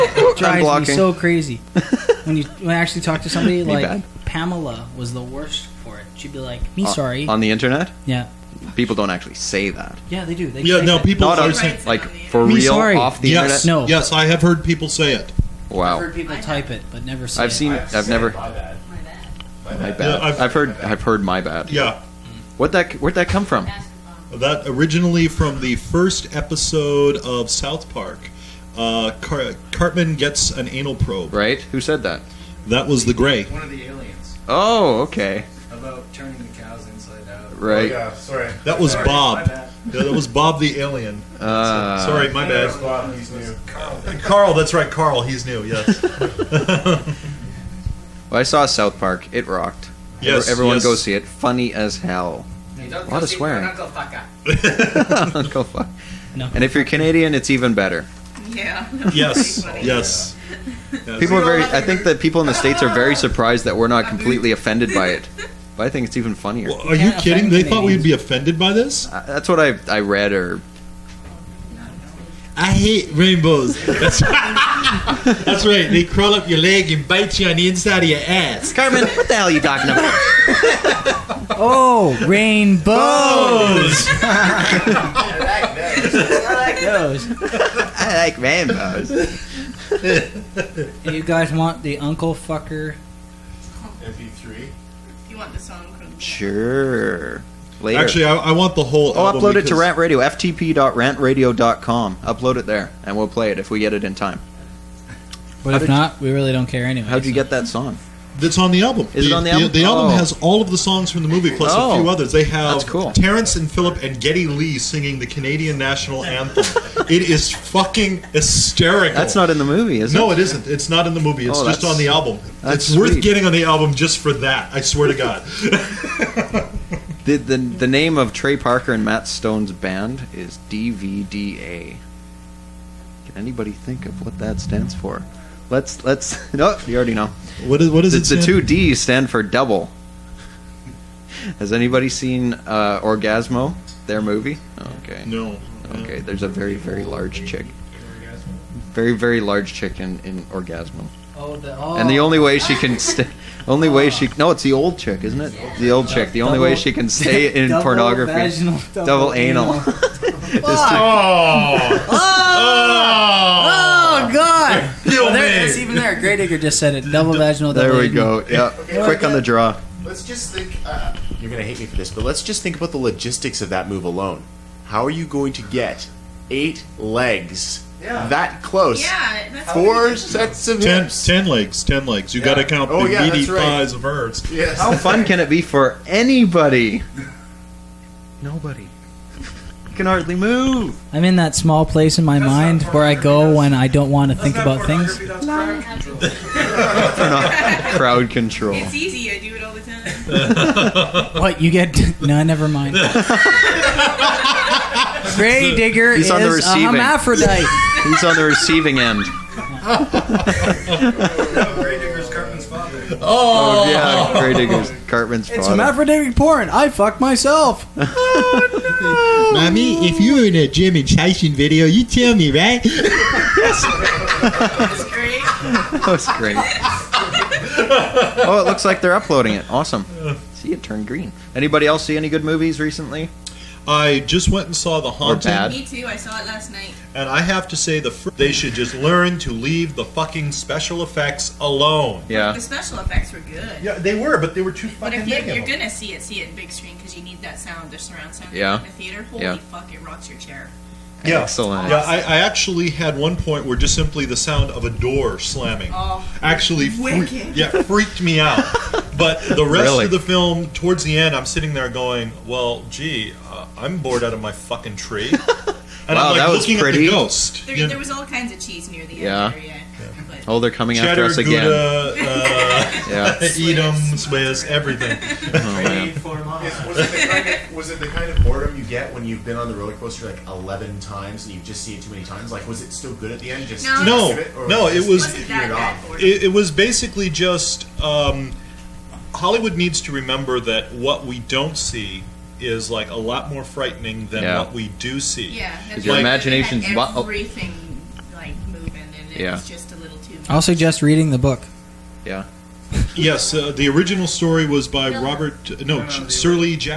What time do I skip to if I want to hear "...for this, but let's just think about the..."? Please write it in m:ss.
2:51.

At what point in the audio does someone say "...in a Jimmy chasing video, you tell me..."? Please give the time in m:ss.
3:40.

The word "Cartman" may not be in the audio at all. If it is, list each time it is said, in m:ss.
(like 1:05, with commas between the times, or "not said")
0:29, 3:35.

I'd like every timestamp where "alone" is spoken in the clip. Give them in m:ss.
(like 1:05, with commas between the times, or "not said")
2:54, 4:01.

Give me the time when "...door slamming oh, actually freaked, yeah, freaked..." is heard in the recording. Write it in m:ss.
4:14.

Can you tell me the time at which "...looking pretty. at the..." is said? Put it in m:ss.
4:26.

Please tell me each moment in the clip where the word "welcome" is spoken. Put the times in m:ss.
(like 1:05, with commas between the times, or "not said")
not said.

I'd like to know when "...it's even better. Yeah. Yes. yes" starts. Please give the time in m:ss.
0:57.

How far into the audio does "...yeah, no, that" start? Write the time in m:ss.
0:10.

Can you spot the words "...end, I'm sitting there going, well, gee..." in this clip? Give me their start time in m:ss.
4:21.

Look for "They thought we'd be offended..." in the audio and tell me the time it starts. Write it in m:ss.
1:07.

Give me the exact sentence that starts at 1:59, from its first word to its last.
That's not in the movie, is no, it?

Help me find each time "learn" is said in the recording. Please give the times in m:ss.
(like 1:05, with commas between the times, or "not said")
3:58.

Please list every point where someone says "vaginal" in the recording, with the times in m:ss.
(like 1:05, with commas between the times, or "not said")
2:38, 2:47.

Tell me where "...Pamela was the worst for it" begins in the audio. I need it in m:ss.
0:04.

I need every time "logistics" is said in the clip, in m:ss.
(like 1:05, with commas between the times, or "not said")
2:52.